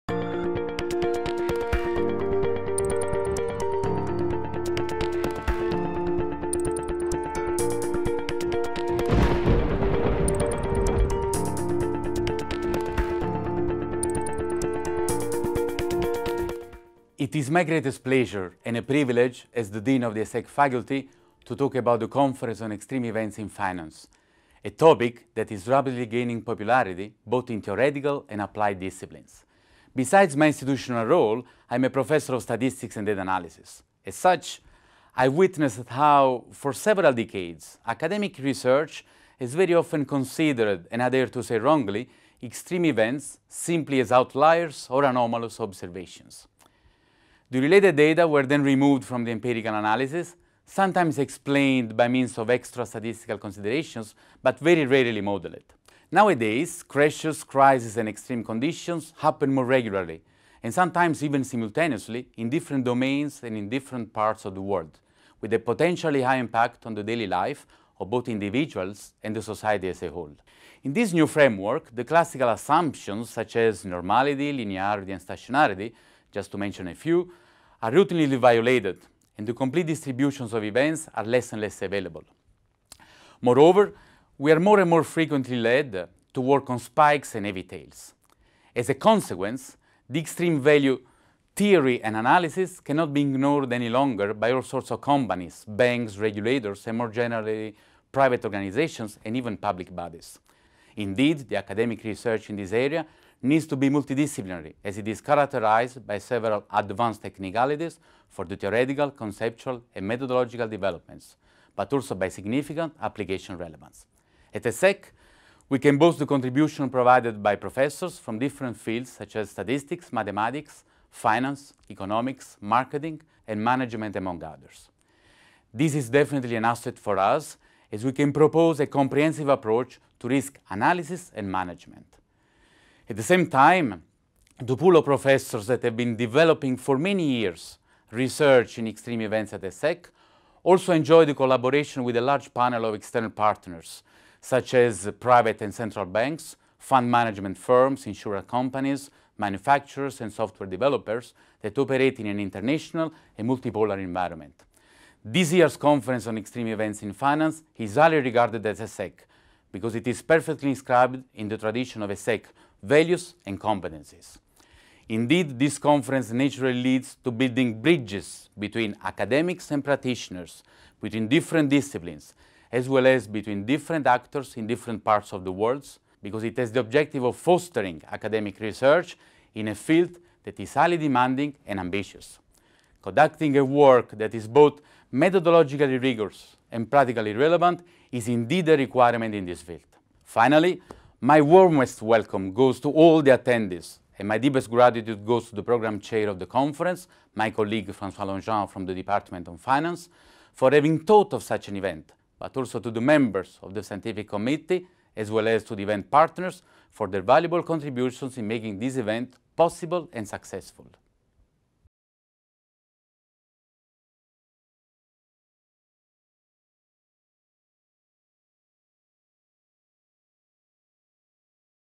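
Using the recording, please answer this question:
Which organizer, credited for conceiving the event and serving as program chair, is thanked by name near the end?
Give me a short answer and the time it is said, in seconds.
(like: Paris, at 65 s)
François Longin, at 197 s.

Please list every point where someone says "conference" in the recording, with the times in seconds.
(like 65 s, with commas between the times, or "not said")
22 s, 155 s, 165 s, 196 s.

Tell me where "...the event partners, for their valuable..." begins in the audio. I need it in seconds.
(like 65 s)
205 s.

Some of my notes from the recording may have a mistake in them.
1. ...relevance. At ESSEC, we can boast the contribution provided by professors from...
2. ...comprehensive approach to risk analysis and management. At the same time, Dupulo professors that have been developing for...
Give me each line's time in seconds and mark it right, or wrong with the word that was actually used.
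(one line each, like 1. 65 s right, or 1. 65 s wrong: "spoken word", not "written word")
1. 113 s right
2. 128 s right.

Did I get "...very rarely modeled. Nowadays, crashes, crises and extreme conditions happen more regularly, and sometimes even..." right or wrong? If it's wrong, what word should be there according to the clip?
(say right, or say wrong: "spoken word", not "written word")
right.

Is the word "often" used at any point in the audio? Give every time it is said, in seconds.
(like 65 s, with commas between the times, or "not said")
39 s.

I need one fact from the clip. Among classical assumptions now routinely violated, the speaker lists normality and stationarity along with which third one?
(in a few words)
Linearity.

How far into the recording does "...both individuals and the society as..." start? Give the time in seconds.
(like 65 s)
68 s.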